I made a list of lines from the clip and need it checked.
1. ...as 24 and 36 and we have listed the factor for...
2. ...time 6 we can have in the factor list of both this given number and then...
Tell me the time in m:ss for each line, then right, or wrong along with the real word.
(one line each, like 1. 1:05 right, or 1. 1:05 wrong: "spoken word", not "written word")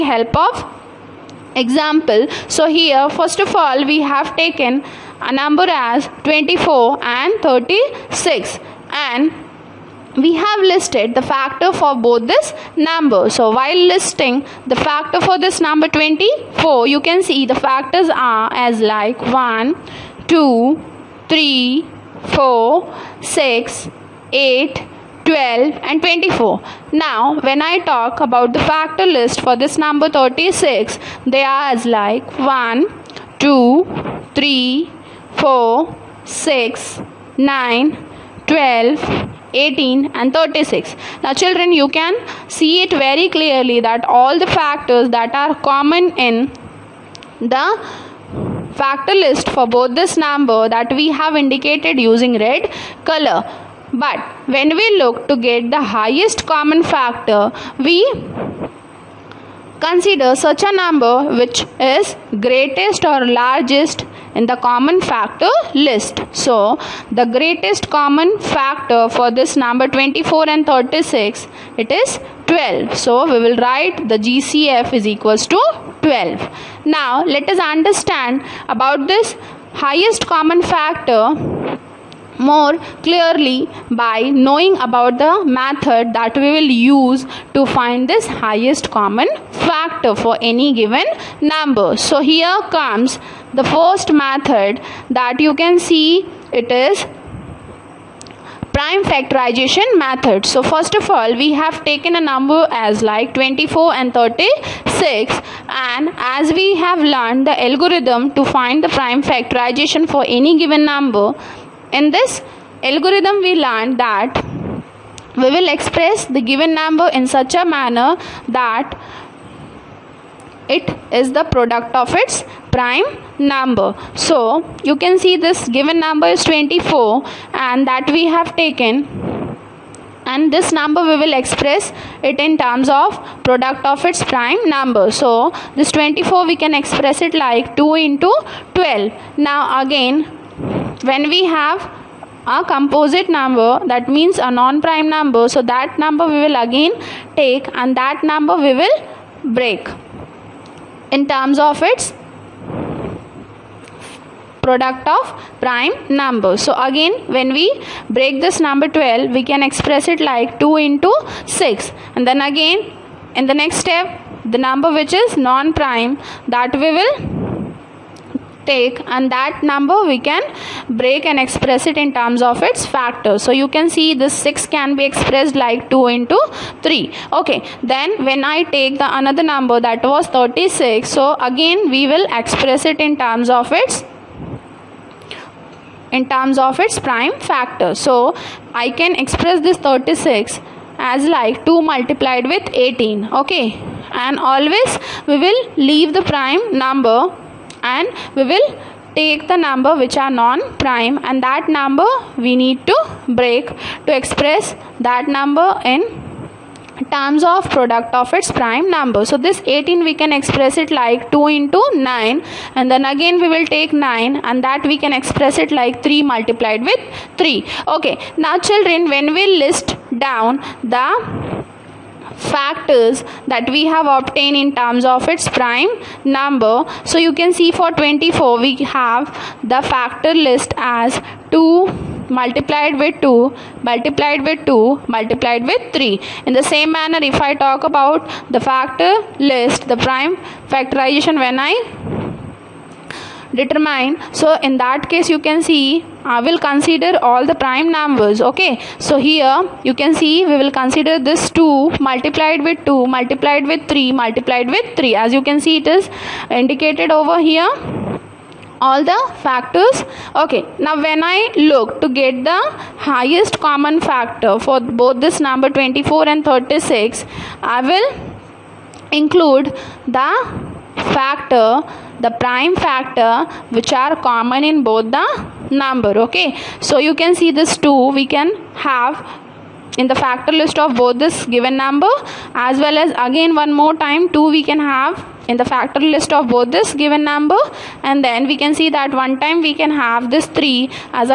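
1. 0:05 right
2. 4:43 wrong: "2", not "6".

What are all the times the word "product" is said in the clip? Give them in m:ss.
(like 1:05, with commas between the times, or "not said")
2:01, 2:13, 2:34, 3:27.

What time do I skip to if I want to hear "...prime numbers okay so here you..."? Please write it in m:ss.
4:07.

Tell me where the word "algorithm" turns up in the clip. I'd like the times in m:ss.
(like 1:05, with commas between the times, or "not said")
1:47, 1:52.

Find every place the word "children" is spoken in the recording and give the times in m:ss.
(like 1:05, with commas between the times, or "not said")
0:41, 3:38.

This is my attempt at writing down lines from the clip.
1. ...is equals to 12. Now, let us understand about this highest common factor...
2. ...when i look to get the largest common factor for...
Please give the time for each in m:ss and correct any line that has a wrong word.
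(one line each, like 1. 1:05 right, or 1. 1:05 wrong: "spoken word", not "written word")
1. 1:14 right
2. 4:21 wrong: "highest", not "largest".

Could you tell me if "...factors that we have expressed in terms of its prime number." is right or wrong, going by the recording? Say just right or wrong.
wrong.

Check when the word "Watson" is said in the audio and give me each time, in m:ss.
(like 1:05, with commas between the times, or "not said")
not said.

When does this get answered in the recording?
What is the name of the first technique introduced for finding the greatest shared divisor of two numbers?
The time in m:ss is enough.
1:38.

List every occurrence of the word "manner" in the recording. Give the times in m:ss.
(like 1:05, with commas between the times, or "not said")
1:57, 3:56.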